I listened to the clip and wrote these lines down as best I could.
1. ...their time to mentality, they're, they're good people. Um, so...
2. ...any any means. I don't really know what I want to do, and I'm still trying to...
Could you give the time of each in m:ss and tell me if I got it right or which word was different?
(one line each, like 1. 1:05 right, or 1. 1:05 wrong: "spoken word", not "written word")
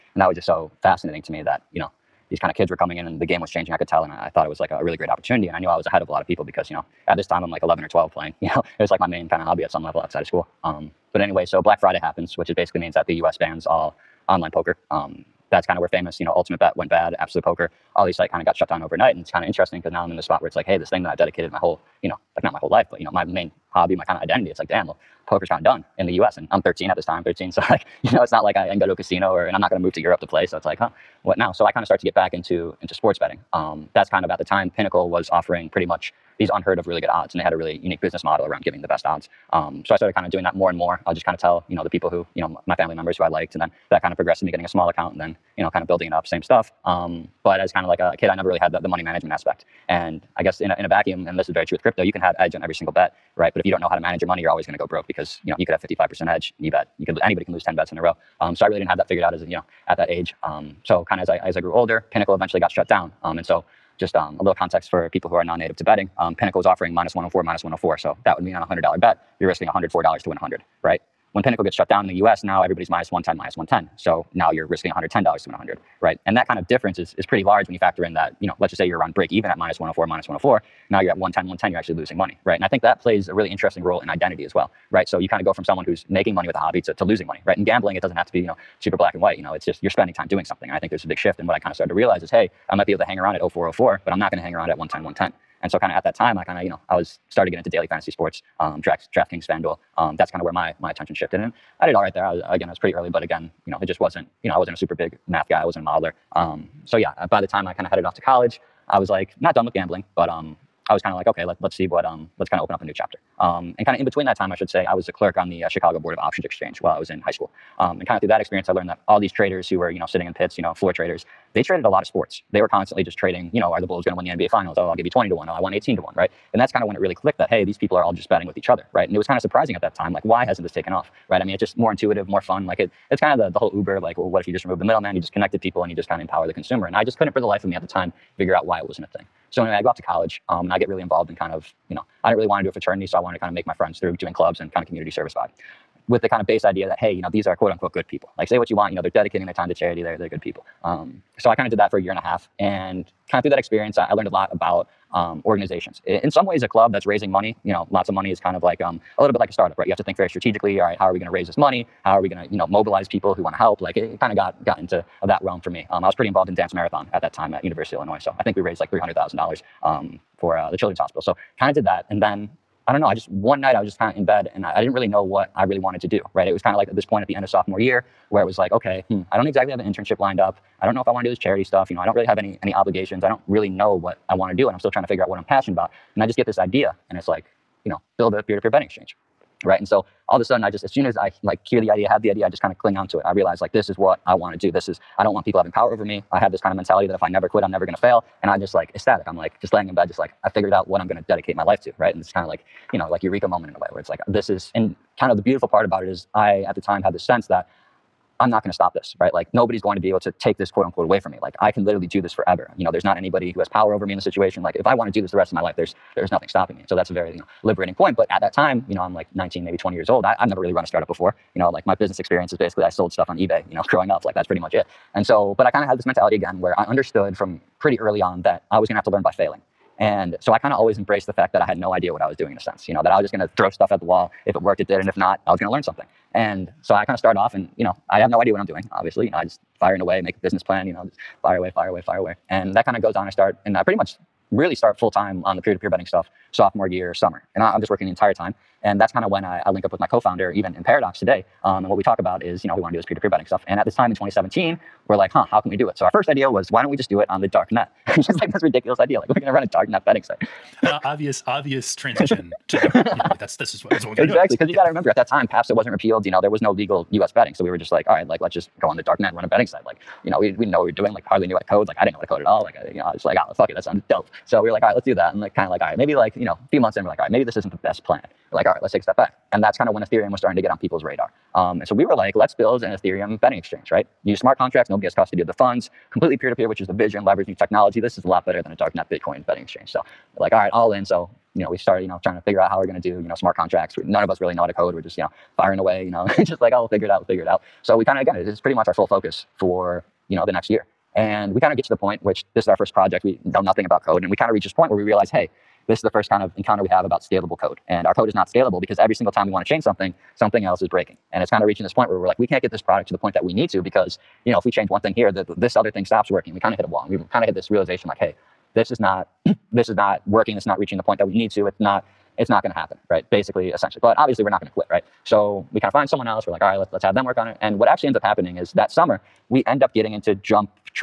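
1. 2:29 wrong: "charity", not "mentality"
2. 3:02 wrong: "obligations", not "means".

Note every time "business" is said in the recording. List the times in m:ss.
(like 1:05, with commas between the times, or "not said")
0:38, 3:41, 4:00.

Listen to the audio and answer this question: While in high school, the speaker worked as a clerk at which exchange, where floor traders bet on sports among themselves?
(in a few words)
Chicago Board of Options Exchange.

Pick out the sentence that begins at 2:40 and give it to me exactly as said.
All right, how are we going to raise this money?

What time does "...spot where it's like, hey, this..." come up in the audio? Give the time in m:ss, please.
0:20.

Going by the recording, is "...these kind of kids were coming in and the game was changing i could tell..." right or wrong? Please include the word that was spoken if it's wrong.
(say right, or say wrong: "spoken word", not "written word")
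right.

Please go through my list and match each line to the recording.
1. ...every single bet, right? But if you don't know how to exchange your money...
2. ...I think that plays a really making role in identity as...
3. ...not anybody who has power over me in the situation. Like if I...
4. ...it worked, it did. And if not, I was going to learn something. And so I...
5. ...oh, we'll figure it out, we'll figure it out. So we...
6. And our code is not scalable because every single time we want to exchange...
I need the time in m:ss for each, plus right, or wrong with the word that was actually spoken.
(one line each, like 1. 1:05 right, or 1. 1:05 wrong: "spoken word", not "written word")
1. 0:52 wrong: "manage", not "exchange"
2. 1:22 wrong: "interesting", not "making"
3. 3:33 right
4. 3:54 right
5. 4:56 right
6. 5:07 wrong: "change", not "exchange".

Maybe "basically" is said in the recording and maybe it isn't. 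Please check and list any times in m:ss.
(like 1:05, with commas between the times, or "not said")
0:12, 3:42, 5:23.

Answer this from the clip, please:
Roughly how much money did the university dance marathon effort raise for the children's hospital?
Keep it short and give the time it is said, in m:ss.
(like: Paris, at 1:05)
$300,000, at 2:48.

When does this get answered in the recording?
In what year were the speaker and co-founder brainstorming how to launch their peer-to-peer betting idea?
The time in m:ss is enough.
4:14.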